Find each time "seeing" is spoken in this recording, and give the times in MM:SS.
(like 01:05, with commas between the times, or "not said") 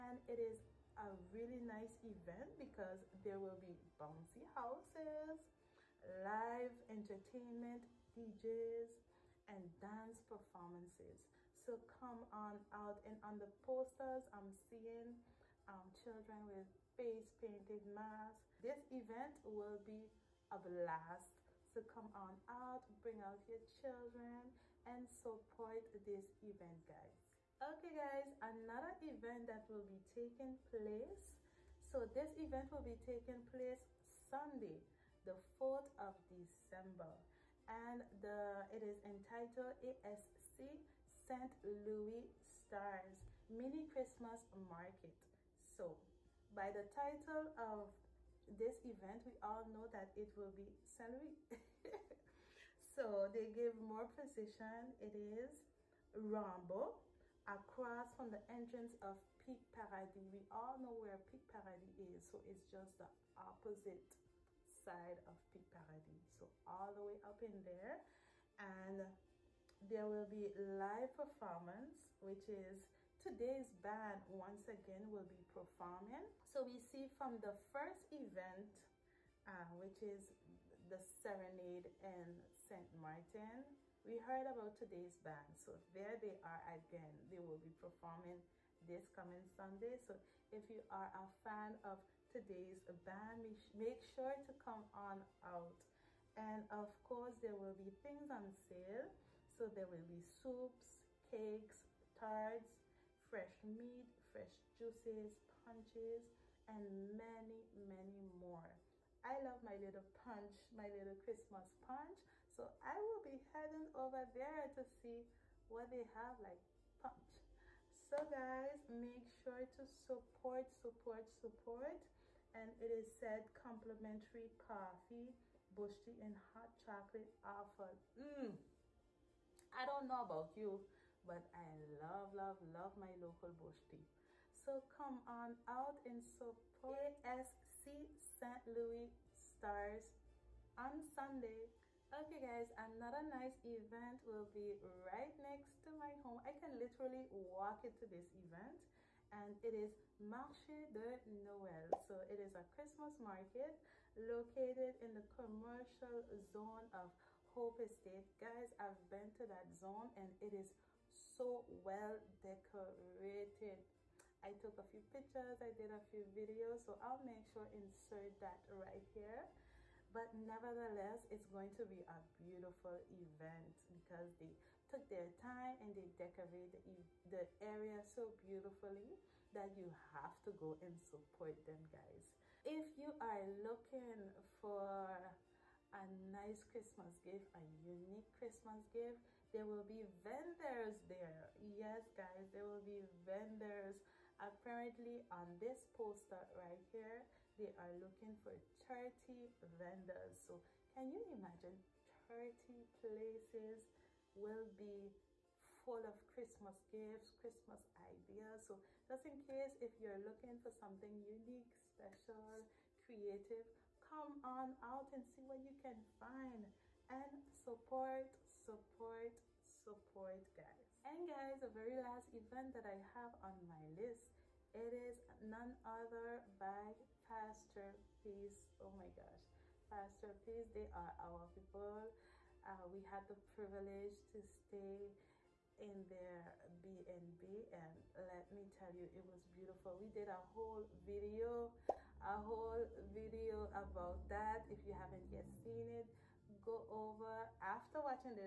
00:14.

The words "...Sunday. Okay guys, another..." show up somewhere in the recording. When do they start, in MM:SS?
02:21.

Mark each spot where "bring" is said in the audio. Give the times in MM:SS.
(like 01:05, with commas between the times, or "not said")
00:23.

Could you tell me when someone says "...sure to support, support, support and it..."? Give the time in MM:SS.
01:59.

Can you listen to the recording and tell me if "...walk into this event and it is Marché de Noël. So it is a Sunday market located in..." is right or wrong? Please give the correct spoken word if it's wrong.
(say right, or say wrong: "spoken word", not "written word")
wrong: "Christmas", not "Sunday".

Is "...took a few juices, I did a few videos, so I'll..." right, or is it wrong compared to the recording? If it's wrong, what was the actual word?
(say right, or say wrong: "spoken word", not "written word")
wrong: "pictures", not "juices".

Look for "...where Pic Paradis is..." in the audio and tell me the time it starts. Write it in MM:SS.
01:00.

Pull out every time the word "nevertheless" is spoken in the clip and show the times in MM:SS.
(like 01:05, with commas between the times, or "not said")
02:50.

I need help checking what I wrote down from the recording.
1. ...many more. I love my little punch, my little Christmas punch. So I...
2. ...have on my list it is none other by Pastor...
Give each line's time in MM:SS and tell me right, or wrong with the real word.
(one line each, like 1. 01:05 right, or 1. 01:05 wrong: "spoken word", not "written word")
1. 01:47 right
2. 03:43 right.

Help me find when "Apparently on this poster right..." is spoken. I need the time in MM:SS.
03:14.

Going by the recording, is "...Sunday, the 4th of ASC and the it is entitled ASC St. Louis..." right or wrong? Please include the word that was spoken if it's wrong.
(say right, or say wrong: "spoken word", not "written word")
wrong: "December", not "ASC".